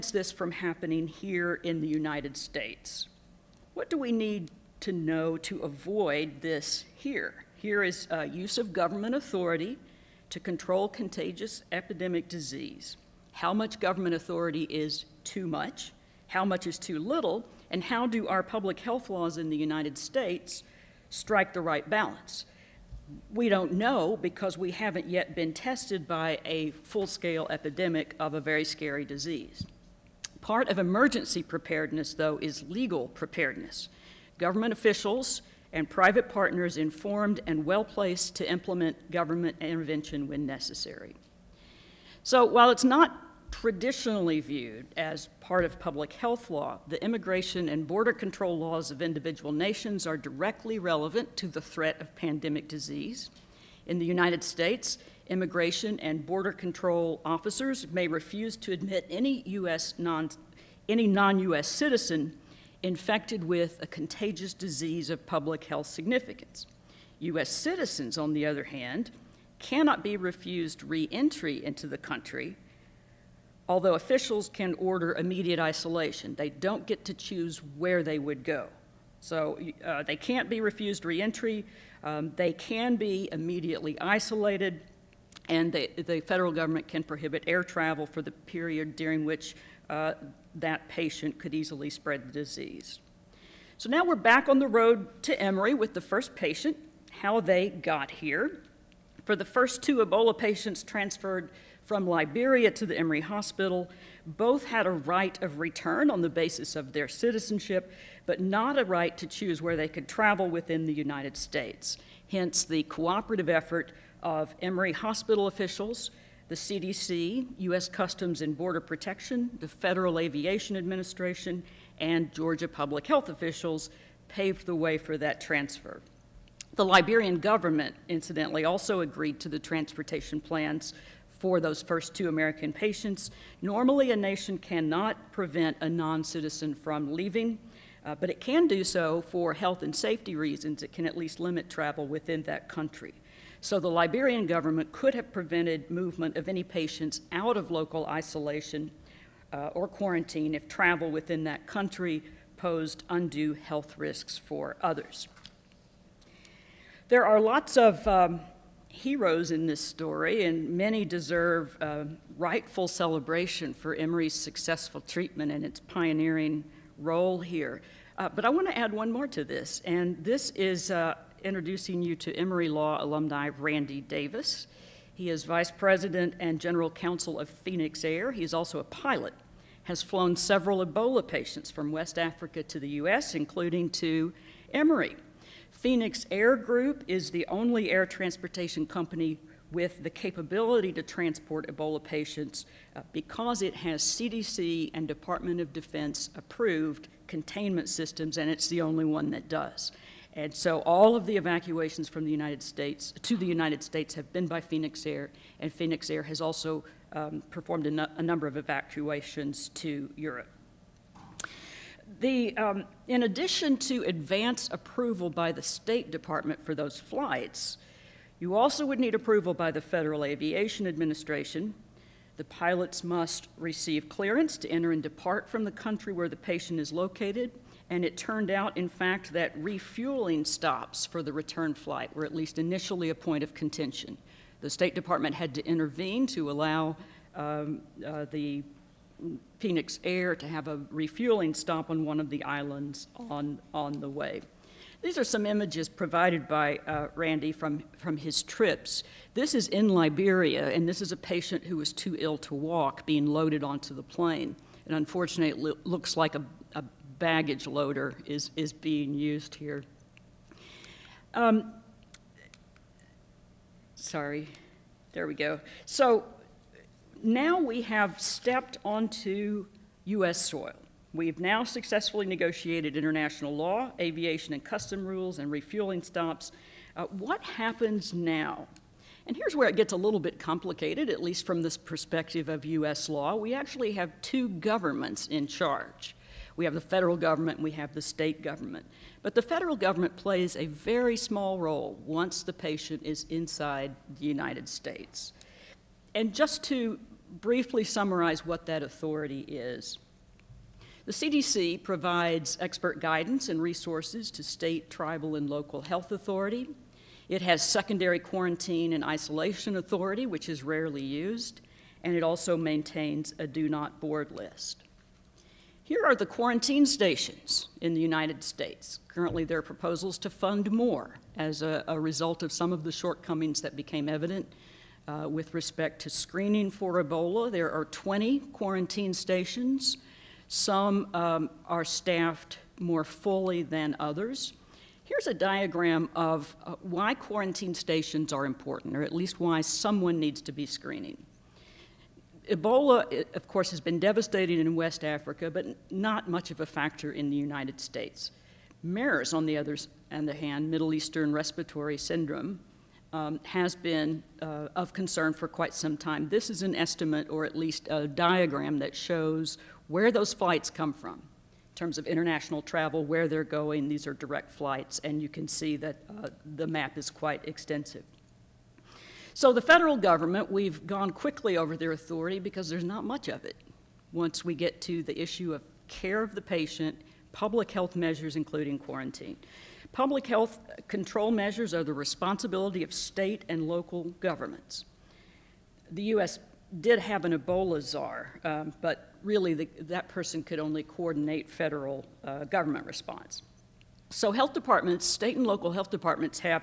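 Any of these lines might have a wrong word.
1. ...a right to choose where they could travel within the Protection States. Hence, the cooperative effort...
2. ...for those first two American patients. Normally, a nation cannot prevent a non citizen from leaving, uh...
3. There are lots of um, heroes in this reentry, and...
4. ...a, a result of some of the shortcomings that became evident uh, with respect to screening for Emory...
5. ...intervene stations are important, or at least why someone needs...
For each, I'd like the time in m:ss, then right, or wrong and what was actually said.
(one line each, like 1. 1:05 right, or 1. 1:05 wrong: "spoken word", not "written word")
1. 1:48 wrong: "United", not "Protection"
2. 2:11 right
3. 2:37 wrong: "story", not "reentry"
4. 5:21 wrong: "Ebola", not "Emory"
5. 5:37 wrong: "quarantine", not "intervene".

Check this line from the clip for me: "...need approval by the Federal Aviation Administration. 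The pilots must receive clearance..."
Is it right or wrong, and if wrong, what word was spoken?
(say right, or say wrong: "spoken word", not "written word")
right.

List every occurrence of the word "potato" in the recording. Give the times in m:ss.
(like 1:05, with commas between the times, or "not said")
not said.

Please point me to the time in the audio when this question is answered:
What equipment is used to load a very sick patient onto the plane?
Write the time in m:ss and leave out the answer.
4:17.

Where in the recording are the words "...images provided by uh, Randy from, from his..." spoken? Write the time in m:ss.
4:05.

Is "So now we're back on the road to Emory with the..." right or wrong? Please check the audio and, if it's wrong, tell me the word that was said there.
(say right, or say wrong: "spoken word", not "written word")
right.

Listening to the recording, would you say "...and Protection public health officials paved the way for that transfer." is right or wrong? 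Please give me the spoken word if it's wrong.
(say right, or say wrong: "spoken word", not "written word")
wrong: "Georgia", not "Protection".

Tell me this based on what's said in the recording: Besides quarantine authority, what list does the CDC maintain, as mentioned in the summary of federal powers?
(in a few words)
do not board list.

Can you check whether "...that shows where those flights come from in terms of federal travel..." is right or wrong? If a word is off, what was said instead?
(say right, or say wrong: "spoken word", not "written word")
wrong: "international", not "federal".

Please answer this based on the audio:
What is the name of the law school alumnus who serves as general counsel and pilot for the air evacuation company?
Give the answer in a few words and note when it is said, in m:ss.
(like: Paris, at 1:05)
Randy Davis, at 2:53.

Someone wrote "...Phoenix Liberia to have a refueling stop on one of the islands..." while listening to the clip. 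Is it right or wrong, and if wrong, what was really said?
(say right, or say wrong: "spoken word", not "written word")
wrong: "Air", not "Liberia".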